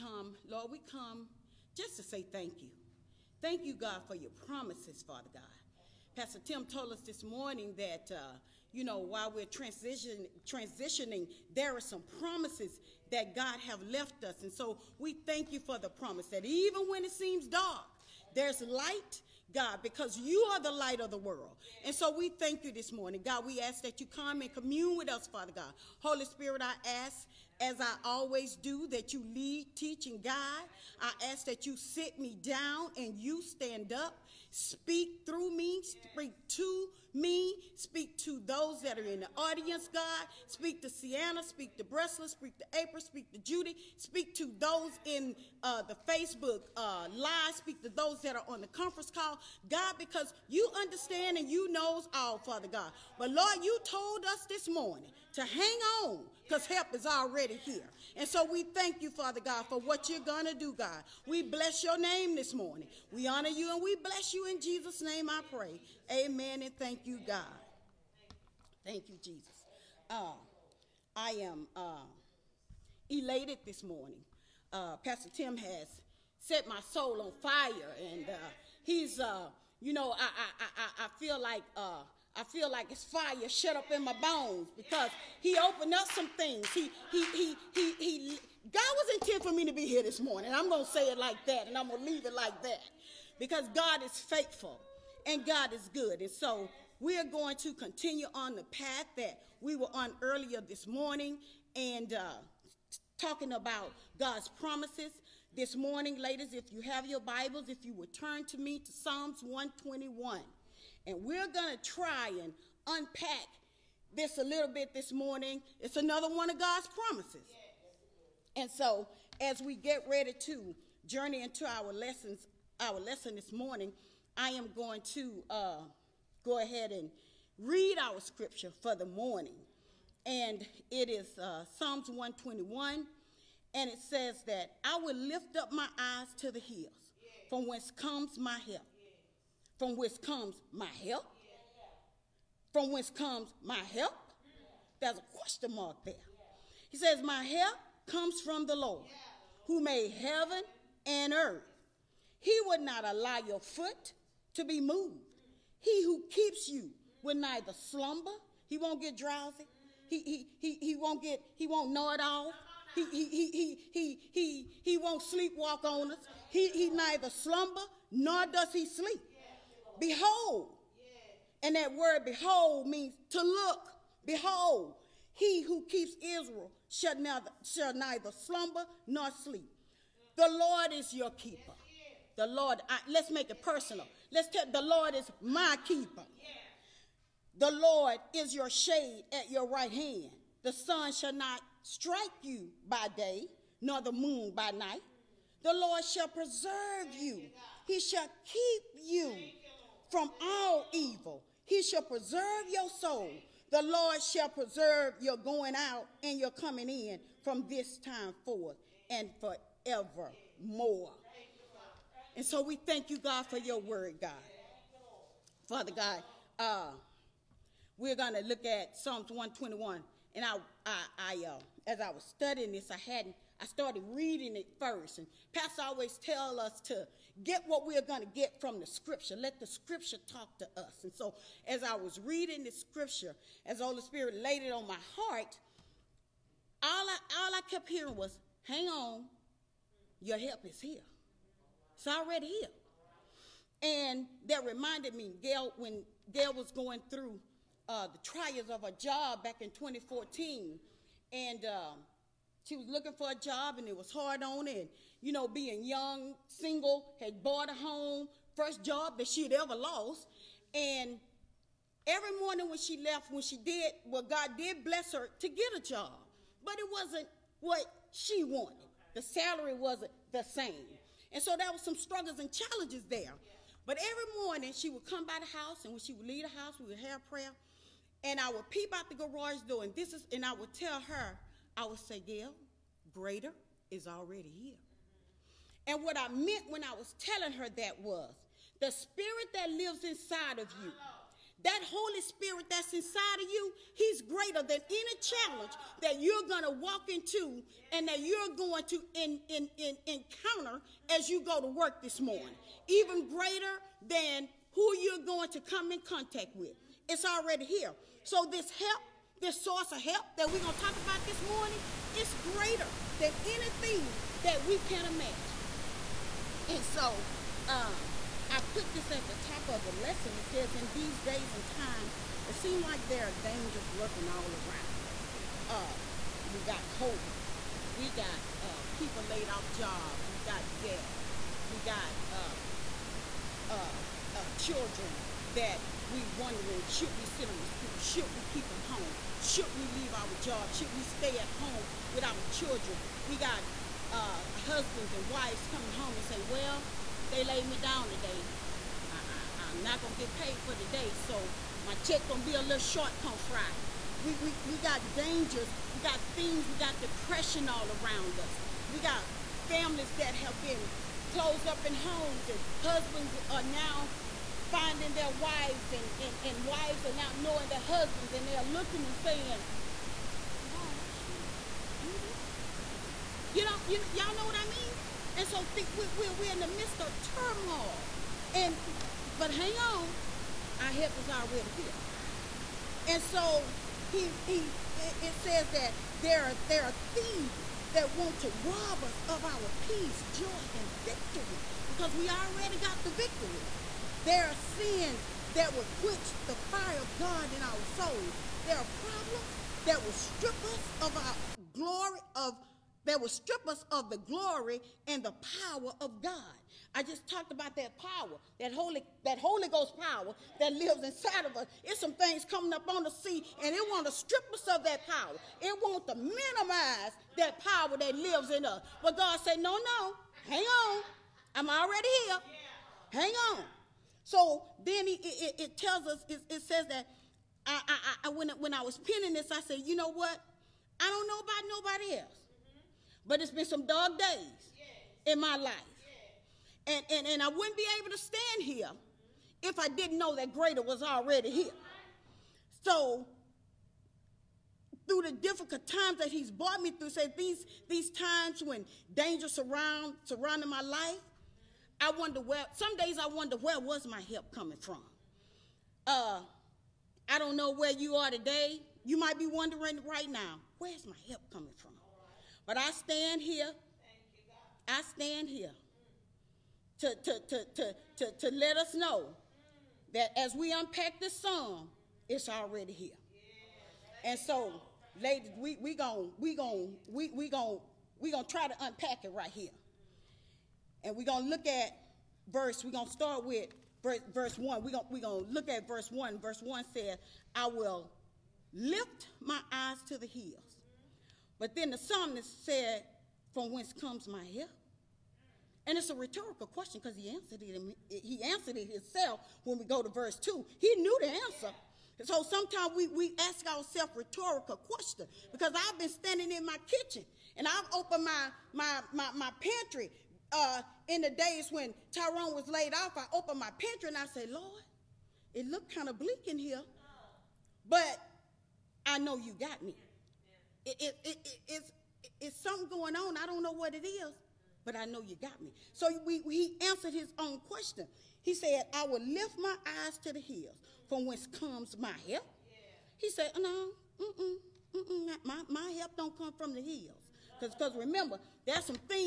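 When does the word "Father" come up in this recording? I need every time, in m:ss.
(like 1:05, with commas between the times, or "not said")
0:05, 0:25, 0:52, 0:59, 3:35.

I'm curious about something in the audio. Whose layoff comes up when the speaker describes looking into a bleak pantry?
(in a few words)
Tyrone.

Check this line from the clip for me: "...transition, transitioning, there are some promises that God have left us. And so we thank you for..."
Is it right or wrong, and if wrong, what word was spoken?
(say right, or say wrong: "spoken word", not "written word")
right.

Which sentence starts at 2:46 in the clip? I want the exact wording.
He, he neither slumber nor does he sleep behold.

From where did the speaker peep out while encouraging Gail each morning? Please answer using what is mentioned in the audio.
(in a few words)
garage door.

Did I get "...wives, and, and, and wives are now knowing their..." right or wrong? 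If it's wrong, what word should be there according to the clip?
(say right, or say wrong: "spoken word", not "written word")
right.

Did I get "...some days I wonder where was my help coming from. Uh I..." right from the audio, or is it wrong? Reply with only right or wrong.
right.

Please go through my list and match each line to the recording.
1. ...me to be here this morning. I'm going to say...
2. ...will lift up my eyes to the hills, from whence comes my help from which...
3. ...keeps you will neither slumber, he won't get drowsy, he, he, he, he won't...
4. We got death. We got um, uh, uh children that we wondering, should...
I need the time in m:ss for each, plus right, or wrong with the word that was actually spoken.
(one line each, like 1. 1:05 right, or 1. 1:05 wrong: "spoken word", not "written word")
1. 1:29 right
2. 2:14 right
3. 2:36 right
4. 5:30 right.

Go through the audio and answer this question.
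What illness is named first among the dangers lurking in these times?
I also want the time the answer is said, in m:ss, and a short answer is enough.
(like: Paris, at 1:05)
COVID, at 5:26.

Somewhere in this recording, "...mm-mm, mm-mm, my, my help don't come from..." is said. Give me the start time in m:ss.
8:54.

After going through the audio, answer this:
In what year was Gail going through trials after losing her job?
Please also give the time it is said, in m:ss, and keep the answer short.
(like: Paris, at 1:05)
2014, at 4:09.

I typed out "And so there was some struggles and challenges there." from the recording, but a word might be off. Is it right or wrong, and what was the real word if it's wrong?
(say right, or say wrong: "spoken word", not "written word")
right.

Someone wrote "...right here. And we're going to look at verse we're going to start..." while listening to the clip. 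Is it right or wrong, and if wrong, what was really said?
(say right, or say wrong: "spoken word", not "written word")
right.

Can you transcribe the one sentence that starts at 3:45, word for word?
And Pastor always tell us to get what we are going to get from the scripture.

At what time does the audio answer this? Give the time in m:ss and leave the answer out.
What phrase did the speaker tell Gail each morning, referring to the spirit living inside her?
4:43.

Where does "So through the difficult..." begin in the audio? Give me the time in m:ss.
7:22.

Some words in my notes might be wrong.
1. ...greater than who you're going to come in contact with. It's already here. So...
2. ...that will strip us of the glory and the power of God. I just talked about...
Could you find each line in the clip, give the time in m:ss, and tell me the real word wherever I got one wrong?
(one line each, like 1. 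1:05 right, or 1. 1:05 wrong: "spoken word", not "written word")
1. 5:03 right
2. 6:43 right.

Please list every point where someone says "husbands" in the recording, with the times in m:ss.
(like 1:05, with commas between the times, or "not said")
5:44, 6:02, 6:07.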